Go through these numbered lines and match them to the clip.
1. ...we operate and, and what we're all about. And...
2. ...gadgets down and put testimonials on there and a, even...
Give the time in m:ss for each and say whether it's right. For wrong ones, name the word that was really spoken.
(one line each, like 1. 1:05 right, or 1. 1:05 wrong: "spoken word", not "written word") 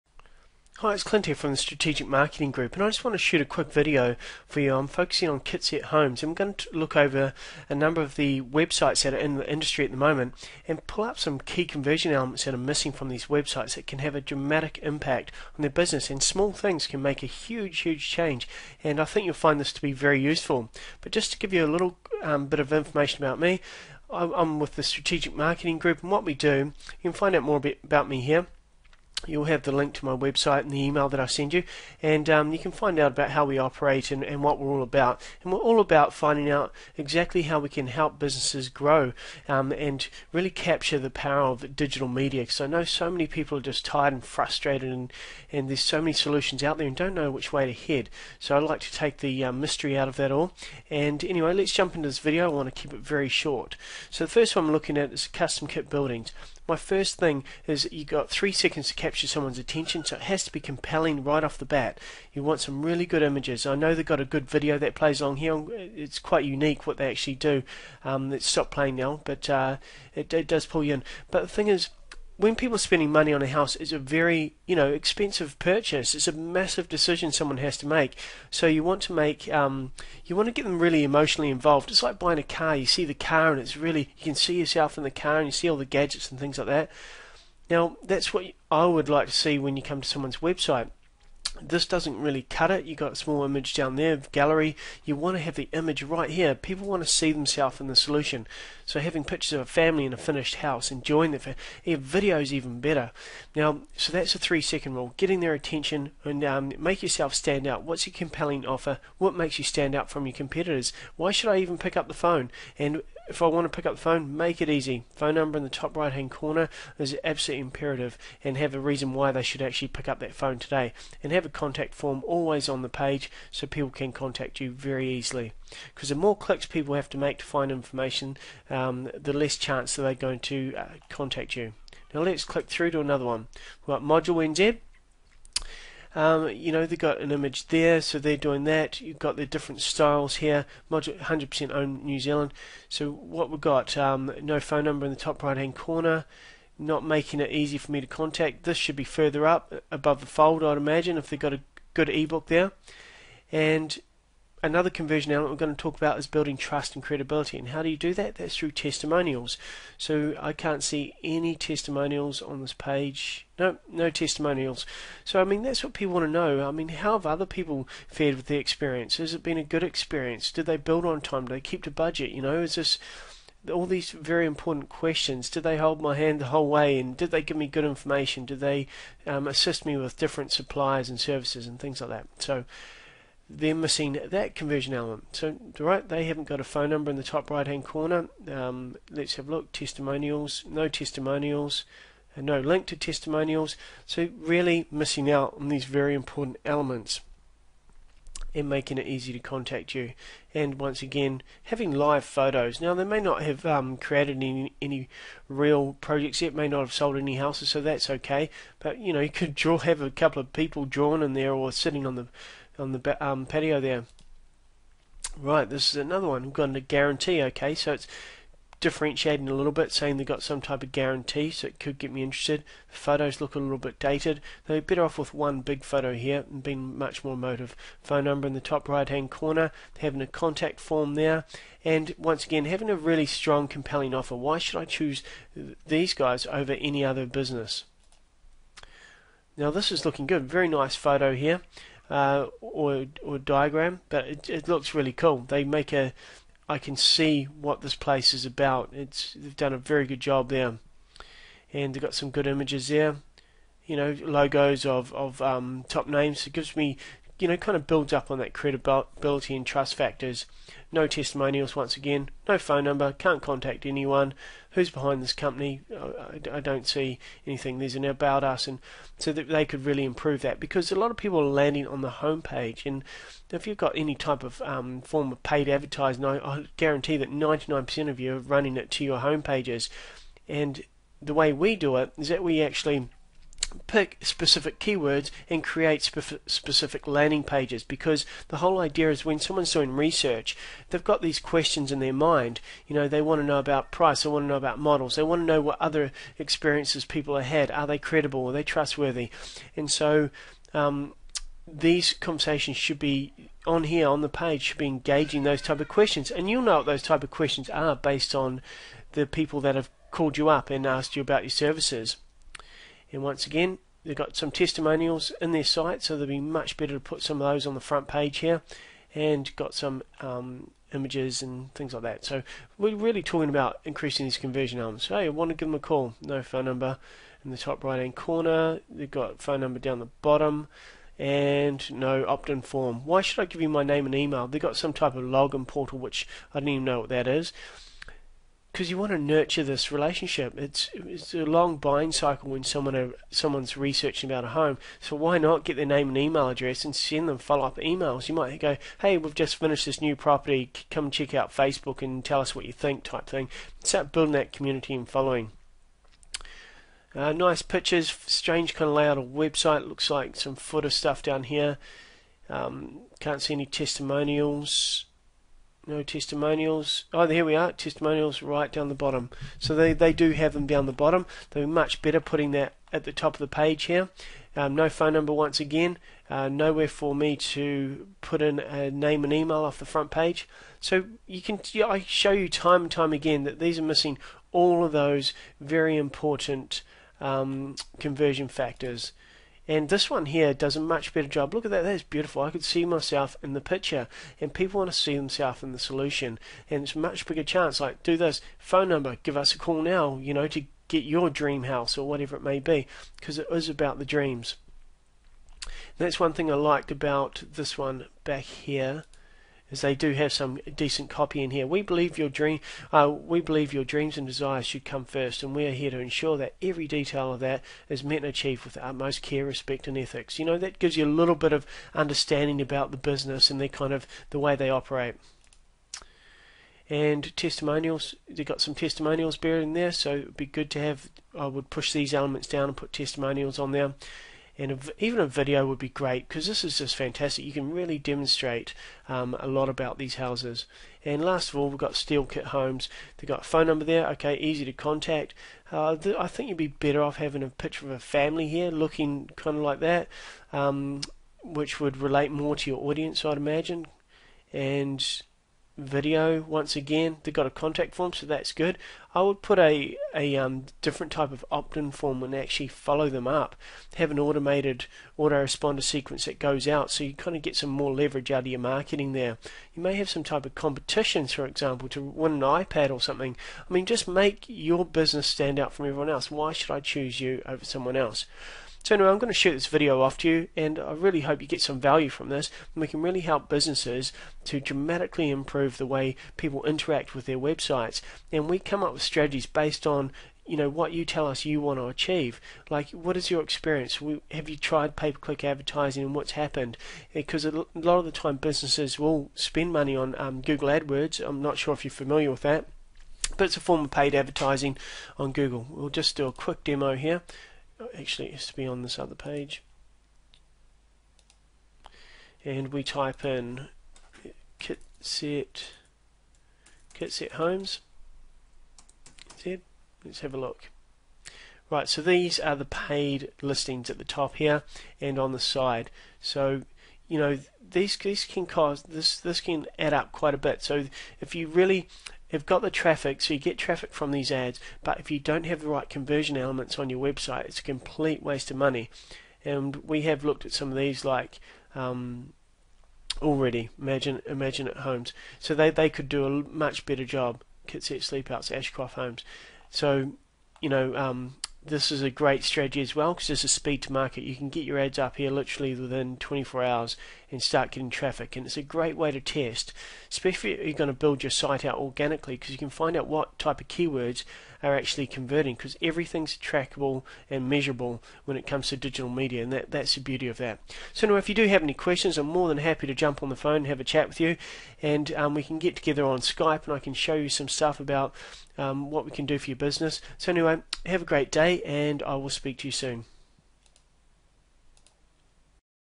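1. 0:33 right
2. 7:12 wrong: "elements", not "gadgets".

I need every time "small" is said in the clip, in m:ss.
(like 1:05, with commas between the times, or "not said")
0:16, 1:33.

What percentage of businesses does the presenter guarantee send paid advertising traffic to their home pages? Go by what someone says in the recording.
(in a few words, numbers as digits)
99%.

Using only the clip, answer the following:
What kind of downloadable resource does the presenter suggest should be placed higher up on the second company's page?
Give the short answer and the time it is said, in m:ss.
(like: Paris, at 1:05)
ebook, at 2:32.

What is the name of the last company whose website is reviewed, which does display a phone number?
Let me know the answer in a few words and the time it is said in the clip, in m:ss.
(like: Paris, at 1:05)
Steel Kit Homes, at 7:21.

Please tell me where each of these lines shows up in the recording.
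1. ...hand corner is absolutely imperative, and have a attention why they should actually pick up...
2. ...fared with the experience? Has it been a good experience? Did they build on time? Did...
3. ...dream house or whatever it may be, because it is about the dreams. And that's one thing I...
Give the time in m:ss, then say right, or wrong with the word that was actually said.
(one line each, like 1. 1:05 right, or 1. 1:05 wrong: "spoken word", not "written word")
1. 1:56 wrong: "reason", not "attention"
2. 2:48 right
3. 6:41 right.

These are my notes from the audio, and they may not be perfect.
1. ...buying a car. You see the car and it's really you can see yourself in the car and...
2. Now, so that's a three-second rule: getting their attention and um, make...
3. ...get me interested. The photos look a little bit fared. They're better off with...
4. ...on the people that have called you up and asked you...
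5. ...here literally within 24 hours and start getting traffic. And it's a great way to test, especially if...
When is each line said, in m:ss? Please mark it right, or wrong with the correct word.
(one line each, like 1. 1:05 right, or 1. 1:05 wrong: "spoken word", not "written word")
1. 1:22 right
2. 1:43 right
3. 3:41 wrong: "dated", not "fared"
4. 5:08 right
5. 9:15 right.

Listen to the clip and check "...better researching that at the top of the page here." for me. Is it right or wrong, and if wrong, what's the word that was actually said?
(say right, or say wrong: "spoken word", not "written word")
wrong: "putting", not "researching".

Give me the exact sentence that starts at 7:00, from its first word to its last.
You know that gives you a little bit of understanding about the business and their kind of the way they operate.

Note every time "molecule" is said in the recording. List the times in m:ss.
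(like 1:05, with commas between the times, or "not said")
not said.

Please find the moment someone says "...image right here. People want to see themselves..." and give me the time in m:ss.
1:35.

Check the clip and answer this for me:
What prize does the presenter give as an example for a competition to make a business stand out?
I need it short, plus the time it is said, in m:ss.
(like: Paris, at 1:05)
iPad, at 7:52.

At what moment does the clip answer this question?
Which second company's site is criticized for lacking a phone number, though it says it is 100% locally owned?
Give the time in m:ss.
2:14.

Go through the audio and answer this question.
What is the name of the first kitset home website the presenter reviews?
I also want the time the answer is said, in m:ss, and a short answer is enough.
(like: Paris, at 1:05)
Custom Kit Buildings, at 0:55.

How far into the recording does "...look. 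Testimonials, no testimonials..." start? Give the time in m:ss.
3:09.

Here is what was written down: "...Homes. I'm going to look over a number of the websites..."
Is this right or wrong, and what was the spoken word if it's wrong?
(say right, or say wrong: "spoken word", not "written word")
right.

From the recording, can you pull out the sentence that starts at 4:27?
There's an about us, and so that they could really improve that because a lot of people are landing on the homepage.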